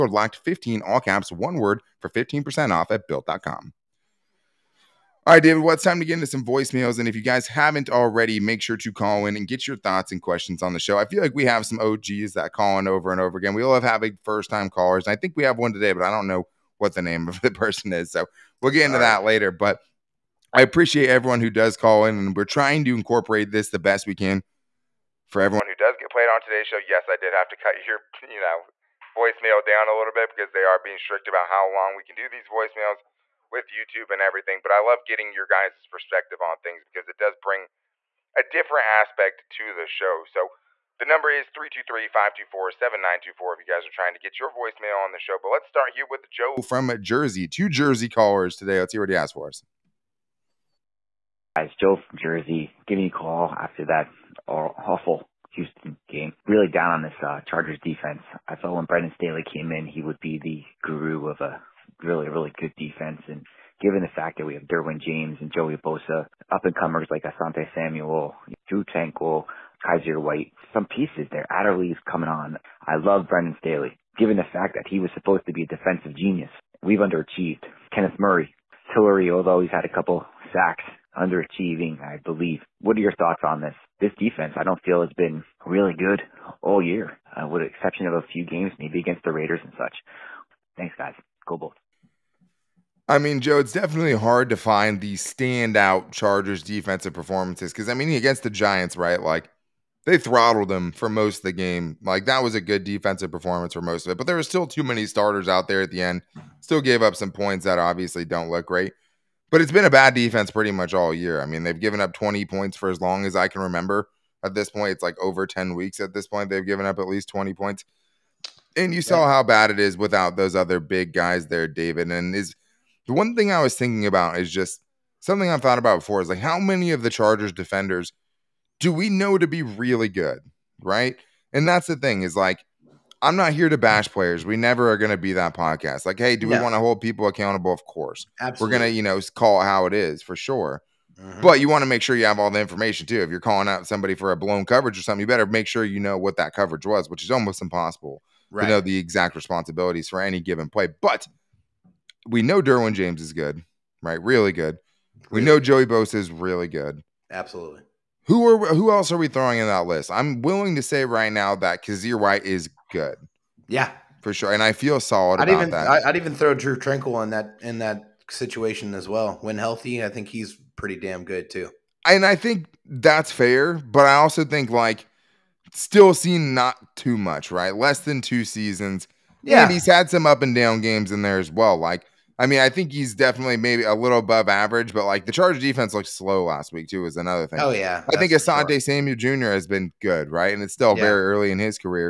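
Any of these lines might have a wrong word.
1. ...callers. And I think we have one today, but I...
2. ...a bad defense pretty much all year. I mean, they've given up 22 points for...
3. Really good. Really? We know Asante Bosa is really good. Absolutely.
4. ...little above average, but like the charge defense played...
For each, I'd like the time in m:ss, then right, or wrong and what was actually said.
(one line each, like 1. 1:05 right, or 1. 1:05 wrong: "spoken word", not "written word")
1. 0:14 right
2. 1:49 wrong: "20", not "22"
3. 2:34 wrong: "Joey", not "Asante"
4. 3:03 wrong: "looked", not "played".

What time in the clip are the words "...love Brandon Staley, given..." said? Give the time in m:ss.
1:12.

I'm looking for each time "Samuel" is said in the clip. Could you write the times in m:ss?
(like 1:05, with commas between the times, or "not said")
1:07, 3:08.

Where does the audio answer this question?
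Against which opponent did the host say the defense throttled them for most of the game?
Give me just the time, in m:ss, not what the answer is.
1:38.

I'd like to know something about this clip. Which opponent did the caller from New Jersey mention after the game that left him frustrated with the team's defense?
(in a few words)
Houston.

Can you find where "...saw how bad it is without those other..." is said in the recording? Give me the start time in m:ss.
1:59.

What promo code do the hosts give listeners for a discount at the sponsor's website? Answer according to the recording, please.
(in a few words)
LOCKED15.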